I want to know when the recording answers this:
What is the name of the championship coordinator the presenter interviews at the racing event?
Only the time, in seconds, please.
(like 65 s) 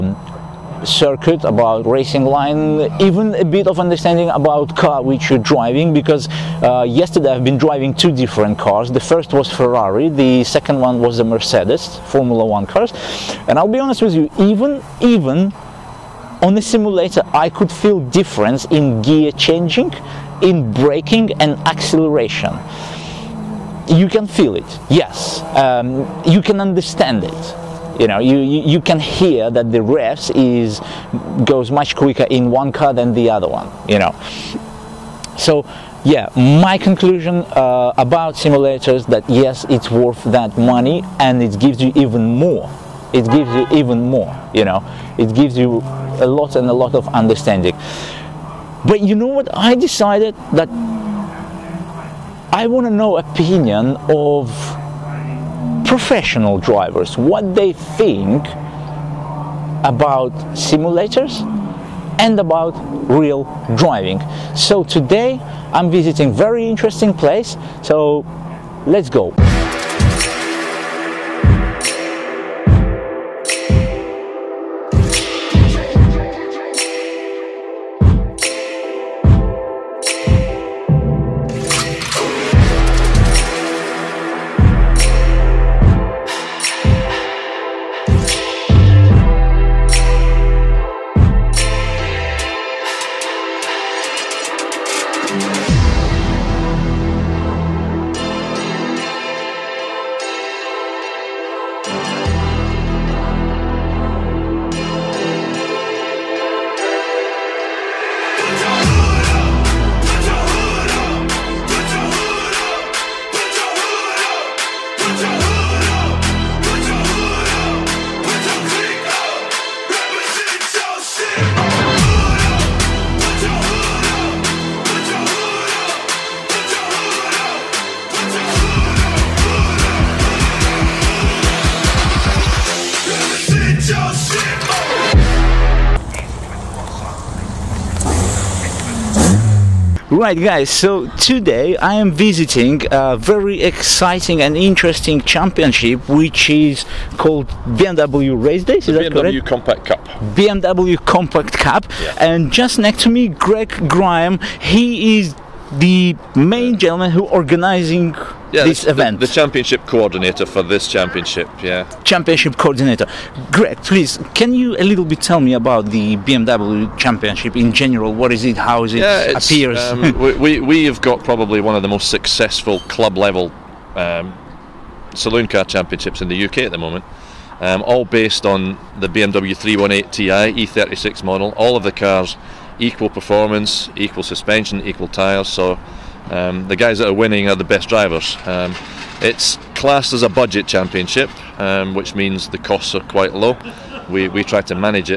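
153 s.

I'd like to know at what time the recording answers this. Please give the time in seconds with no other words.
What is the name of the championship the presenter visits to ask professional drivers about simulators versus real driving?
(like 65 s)
150 s.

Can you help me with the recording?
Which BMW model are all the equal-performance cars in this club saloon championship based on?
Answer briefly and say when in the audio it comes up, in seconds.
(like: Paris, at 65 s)
318 Ti E36, at 179 s.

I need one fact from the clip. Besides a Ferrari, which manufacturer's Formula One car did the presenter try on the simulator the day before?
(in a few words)
Mercedes.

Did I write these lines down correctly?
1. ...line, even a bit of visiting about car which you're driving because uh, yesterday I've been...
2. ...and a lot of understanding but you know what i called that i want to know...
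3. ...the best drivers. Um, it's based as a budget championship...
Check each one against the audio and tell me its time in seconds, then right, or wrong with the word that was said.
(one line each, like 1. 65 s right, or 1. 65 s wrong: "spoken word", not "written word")
1. 2 s wrong: "understanding", not "visiting"
2. 46 s wrong: "decided", not "called"
3. 187 s wrong: "classed", not "based".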